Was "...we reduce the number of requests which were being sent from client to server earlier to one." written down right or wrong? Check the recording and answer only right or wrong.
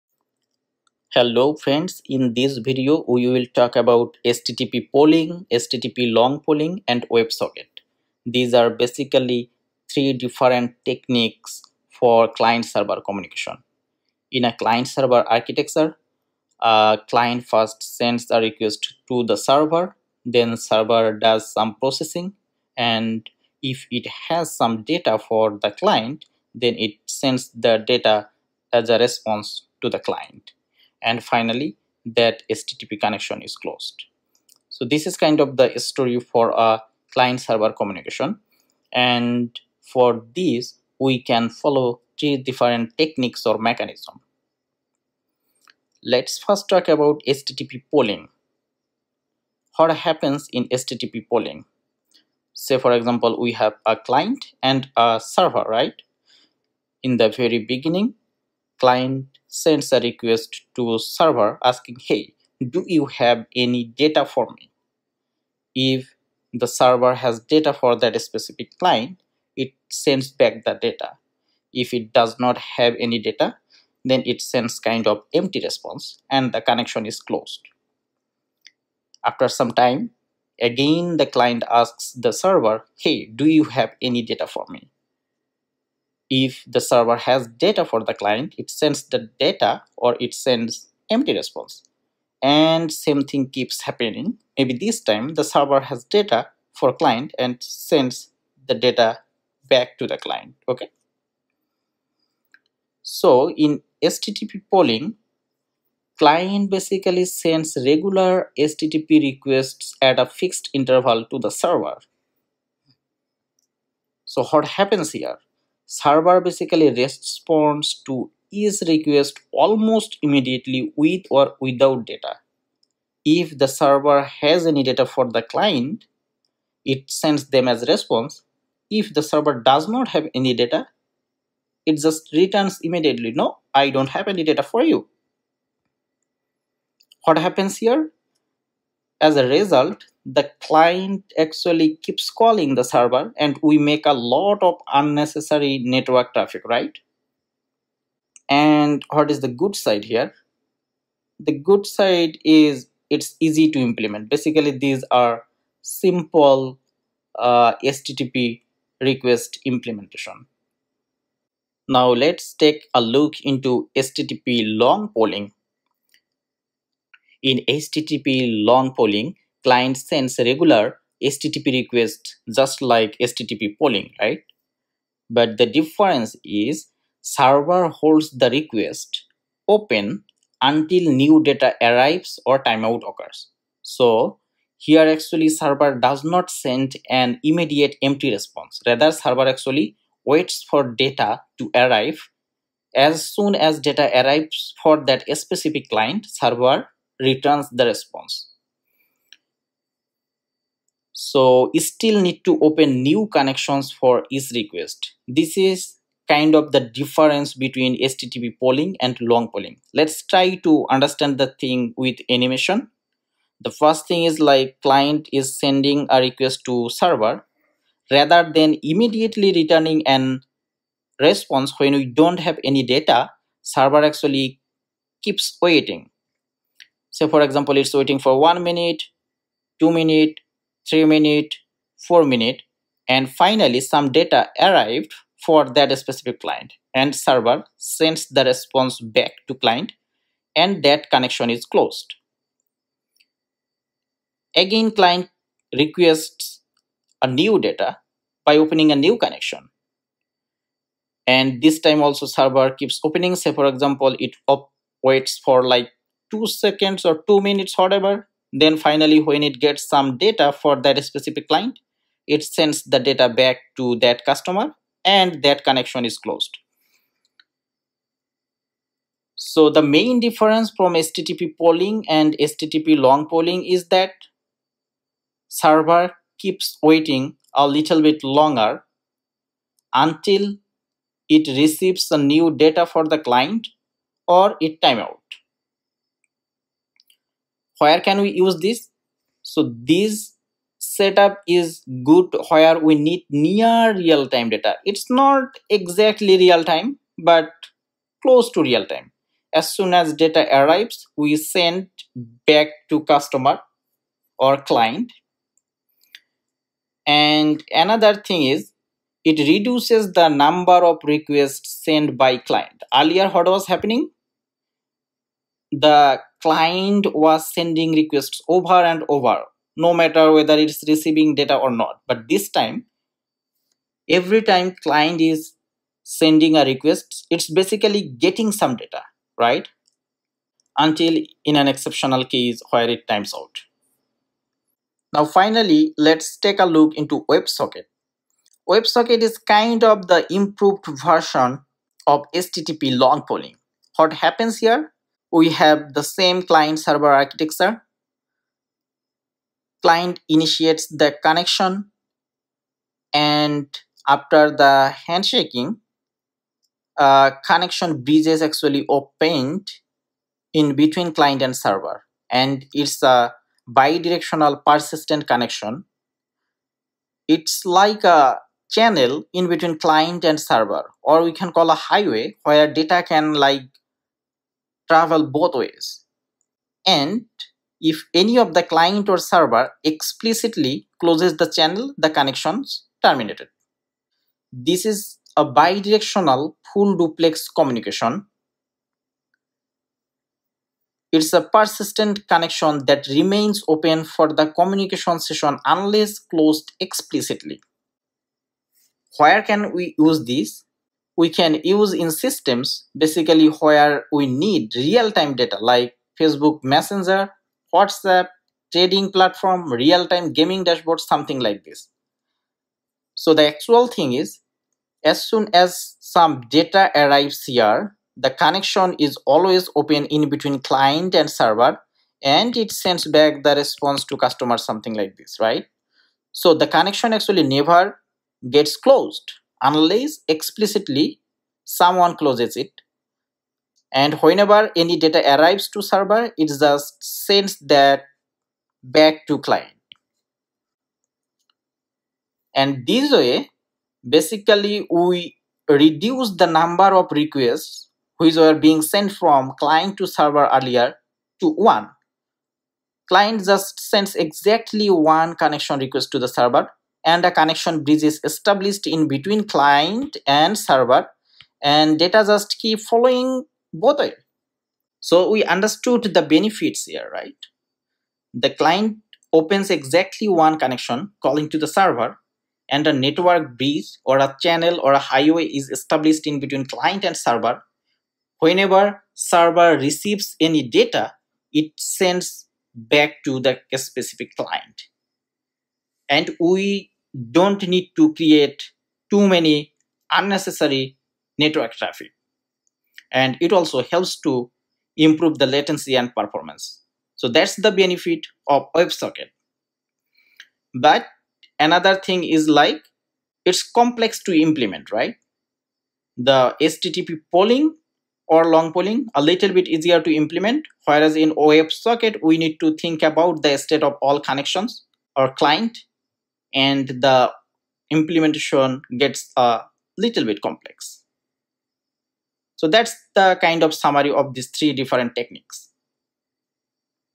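right.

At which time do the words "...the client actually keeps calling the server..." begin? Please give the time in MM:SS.
02:20.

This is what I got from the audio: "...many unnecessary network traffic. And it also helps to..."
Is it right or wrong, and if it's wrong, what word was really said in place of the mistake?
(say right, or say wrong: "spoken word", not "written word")
right.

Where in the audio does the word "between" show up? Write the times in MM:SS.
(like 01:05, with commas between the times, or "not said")
03:27, 06:00, 06:09, 07:00, 07:39, 07:56.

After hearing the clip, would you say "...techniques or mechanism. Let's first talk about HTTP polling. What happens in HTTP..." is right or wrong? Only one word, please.
right.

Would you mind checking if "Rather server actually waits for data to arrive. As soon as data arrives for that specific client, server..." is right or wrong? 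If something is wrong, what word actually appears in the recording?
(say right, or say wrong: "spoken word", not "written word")
right.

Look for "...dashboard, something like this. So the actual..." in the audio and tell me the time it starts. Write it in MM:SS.
06:50.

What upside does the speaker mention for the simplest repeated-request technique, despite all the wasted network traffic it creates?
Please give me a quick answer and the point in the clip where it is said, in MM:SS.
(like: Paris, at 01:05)
easy to implement, at 02:33.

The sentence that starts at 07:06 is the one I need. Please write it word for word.
So the connection actually never gets closed unless explicitly someone closes it.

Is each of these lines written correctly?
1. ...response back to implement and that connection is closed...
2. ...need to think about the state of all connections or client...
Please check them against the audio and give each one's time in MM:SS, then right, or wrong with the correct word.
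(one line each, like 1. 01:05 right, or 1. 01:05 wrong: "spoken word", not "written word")
1. 03:58 wrong: "client", not "implement"
2. 08:32 right.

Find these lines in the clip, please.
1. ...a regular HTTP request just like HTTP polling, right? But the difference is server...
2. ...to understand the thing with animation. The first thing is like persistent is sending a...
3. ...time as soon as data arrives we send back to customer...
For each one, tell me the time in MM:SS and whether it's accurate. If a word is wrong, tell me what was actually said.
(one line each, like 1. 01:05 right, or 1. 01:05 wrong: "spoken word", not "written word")
1. 02:50 right
2. 03:30 wrong: "client", not "persistent"
3. 04:58 right.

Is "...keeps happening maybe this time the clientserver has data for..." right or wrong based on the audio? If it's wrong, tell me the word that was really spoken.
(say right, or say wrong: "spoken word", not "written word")
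wrong: "server", not "clientserver".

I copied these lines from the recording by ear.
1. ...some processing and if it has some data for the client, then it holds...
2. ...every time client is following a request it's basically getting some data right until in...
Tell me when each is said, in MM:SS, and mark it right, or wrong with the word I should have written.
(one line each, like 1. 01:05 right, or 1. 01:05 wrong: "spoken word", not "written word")
1. 00:21 wrong: "sends", not "holds"
2. 05:24 wrong: "sending", not "following".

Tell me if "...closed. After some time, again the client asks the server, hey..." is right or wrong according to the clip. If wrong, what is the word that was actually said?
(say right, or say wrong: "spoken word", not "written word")
right.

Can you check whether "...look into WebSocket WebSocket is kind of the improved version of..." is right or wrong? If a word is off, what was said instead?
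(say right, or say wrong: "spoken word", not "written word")
right.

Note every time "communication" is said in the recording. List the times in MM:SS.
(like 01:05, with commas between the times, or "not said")
00:13, 00:37, 06:27, 06:34.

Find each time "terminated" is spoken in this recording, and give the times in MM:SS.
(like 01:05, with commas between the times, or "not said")
06:23.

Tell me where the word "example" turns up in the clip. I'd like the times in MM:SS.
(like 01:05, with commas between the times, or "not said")
00:52, 03:47, 04:13.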